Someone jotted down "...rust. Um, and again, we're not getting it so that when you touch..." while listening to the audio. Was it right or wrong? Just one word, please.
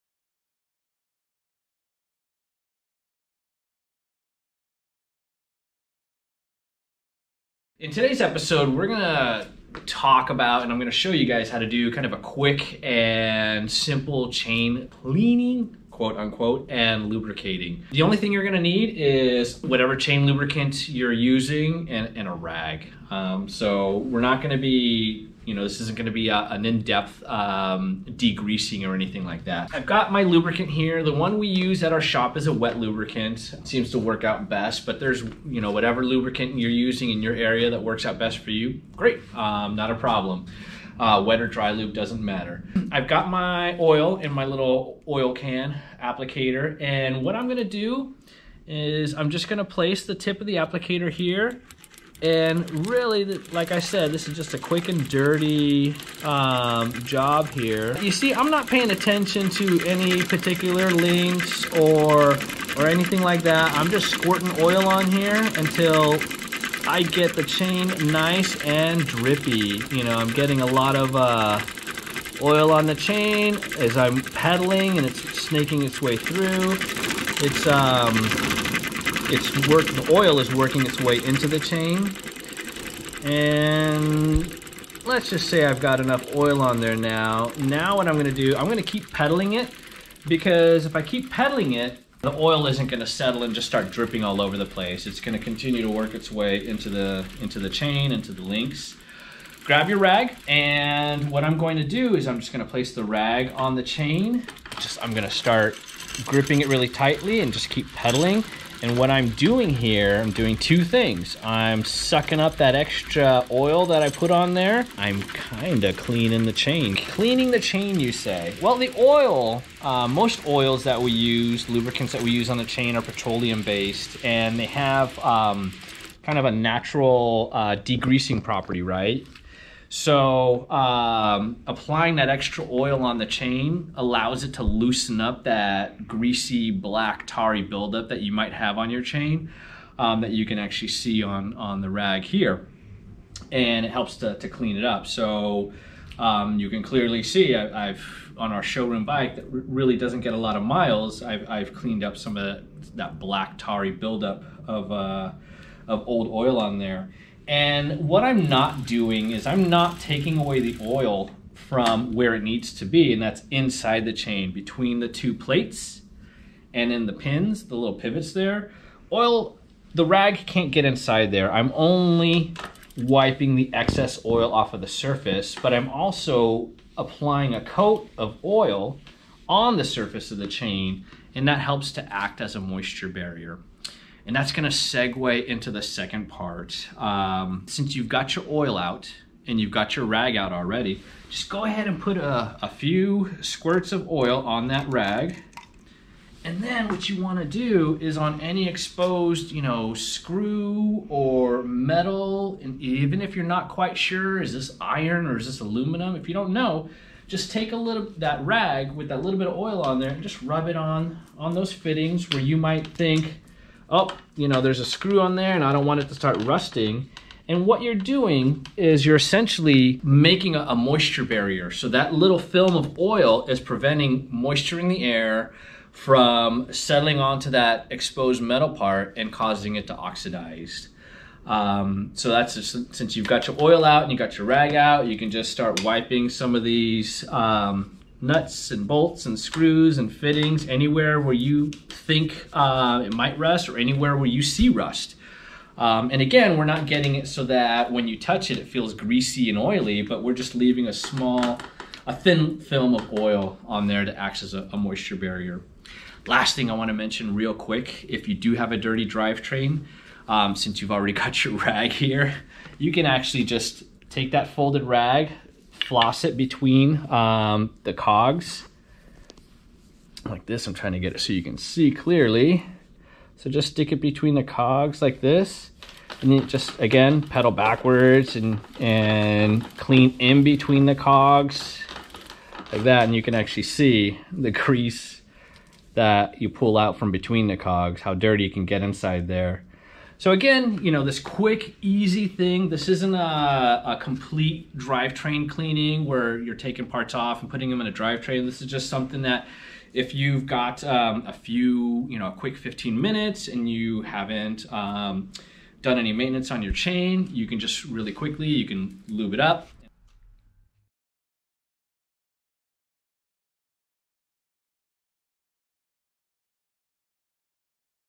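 right.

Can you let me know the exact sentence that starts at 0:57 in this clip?
You see, I'm not paying attention to any particular links or or anything like that.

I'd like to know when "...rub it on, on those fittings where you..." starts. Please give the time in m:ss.
3:30.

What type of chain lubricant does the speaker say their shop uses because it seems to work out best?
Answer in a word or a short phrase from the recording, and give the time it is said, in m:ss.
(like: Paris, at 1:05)
wet lubricant, at 0:32.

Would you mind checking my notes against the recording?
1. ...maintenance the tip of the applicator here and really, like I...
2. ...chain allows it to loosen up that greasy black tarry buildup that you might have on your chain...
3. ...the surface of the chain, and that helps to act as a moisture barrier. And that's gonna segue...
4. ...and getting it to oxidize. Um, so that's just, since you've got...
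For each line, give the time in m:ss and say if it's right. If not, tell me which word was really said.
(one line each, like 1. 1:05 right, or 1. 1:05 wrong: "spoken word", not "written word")
1. 0:49 wrong: "place", not "maintenance"
2. 2:13 right
3. 2:59 right
4. 3:49 wrong: "causing", not "getting".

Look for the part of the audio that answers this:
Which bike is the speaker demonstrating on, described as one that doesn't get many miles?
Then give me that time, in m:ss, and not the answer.
2:28.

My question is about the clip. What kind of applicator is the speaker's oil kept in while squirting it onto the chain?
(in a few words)
oil can applicator.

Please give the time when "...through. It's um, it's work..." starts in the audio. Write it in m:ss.
1:16.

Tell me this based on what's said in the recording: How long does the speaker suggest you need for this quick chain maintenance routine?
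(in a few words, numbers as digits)
15 minutes.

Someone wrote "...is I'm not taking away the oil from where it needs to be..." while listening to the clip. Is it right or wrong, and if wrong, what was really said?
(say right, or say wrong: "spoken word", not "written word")
right.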